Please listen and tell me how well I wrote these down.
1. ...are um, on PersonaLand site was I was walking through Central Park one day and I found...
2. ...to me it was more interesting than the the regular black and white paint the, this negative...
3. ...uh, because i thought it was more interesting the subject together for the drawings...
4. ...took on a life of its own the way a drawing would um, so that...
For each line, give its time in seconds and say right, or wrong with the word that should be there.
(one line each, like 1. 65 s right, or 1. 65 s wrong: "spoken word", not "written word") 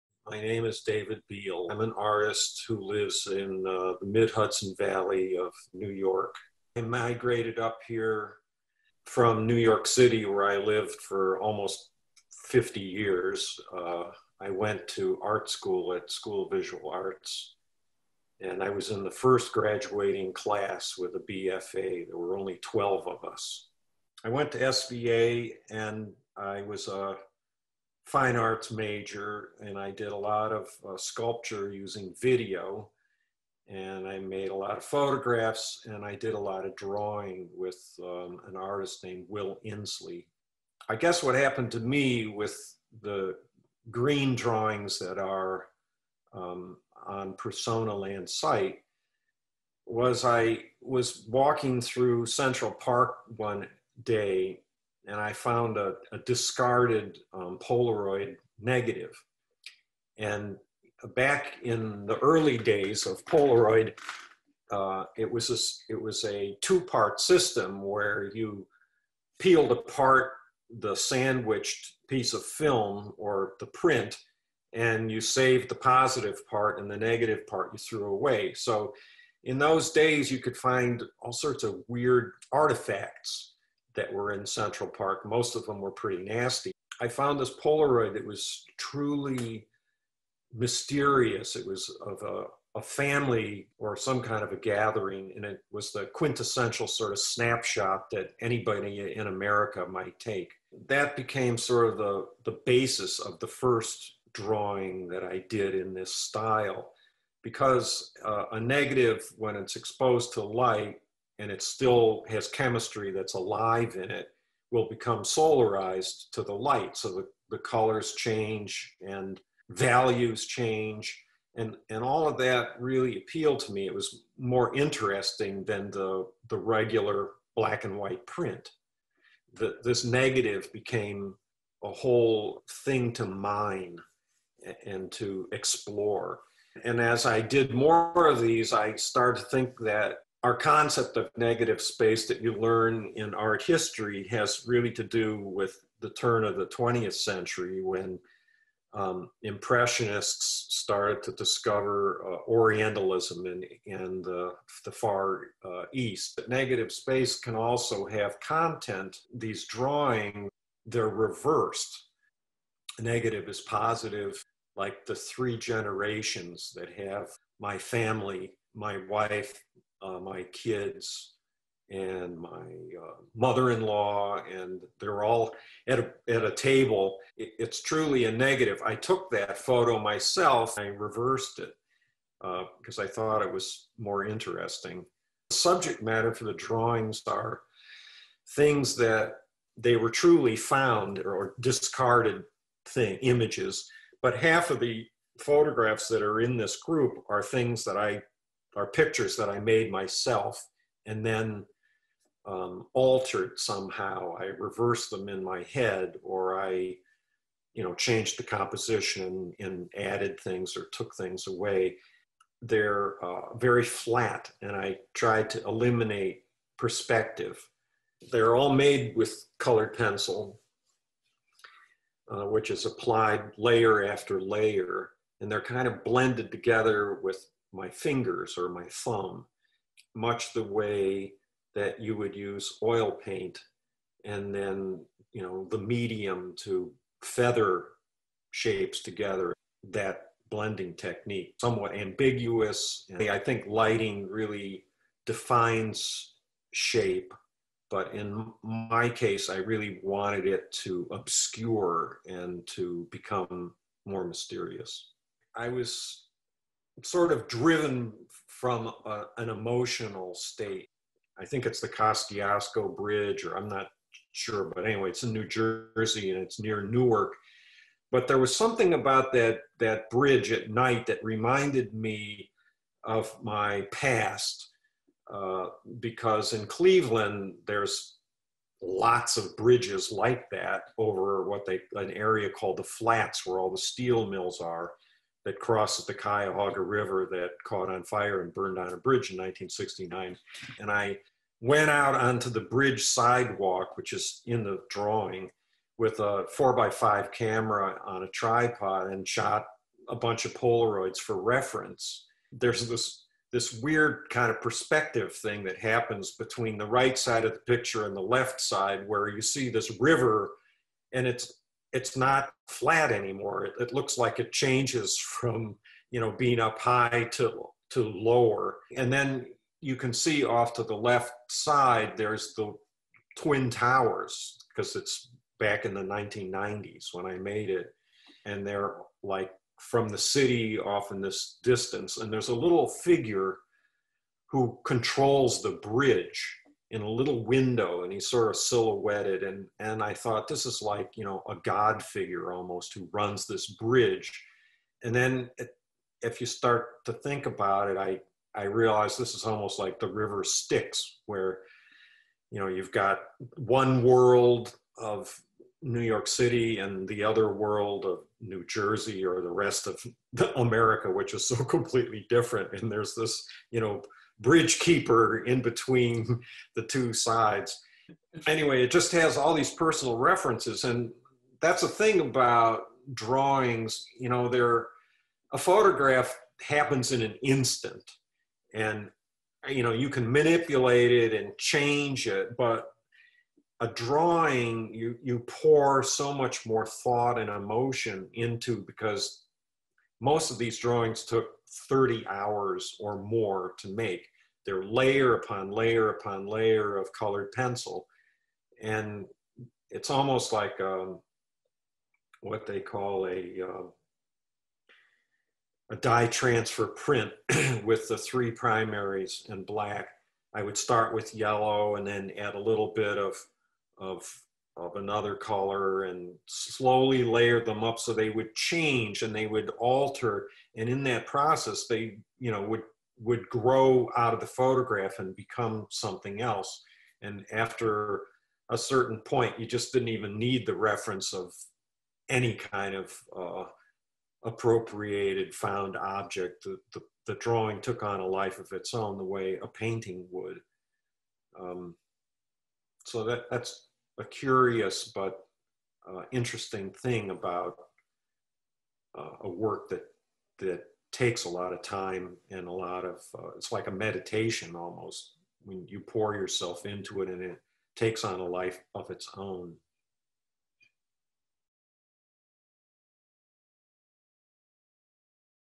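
1. 45 s right
2. 123 s wrong: "print", not "paint"
3. 182 s wrong: "matter", not "together"
4. 437 s wrong: "painting", not "drawing".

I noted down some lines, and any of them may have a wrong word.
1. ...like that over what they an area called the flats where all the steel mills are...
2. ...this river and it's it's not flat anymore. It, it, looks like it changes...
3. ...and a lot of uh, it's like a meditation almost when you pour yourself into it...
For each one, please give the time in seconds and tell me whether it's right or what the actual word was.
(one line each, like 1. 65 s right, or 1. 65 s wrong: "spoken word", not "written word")
1. 280 s right
2. 309 s right
3. 452 s right.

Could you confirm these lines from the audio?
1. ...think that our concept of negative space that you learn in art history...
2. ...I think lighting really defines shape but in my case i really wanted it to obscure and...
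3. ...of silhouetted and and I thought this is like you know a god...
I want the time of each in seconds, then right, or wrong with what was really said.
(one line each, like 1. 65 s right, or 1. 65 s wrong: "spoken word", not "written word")
1. 139 s right
2. 243 s right
3. 338 s right.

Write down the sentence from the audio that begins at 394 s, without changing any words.
They're layer upon layer upon layer of colored pencil.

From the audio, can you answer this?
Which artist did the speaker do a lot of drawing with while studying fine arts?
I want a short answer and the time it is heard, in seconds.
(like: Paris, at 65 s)
Will Insley, at 39 s.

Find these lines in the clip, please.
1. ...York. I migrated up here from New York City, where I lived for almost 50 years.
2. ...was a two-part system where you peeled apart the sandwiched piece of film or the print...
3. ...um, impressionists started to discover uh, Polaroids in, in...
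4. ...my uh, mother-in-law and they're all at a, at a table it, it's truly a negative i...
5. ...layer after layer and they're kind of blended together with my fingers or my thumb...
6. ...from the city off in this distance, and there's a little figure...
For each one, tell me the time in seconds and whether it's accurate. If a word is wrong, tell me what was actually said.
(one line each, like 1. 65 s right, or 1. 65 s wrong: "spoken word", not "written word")
1. 5 s right
2. 66 s right
3. 148 s wrong: "Orientalism", not "Polaroids"
4. 172 s right
5. 223 s right
6. 329 s right.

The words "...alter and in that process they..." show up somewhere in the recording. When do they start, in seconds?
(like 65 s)
419 s.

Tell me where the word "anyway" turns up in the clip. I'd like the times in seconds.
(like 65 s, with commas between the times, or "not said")
264 s, 368 s.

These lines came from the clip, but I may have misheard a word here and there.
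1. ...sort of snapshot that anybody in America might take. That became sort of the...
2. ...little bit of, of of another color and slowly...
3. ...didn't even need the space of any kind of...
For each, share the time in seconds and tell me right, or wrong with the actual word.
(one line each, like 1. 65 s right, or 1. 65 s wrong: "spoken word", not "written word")
1. 96 s right
2. 412 s right
3. 429 s wrong: "reference", not "space".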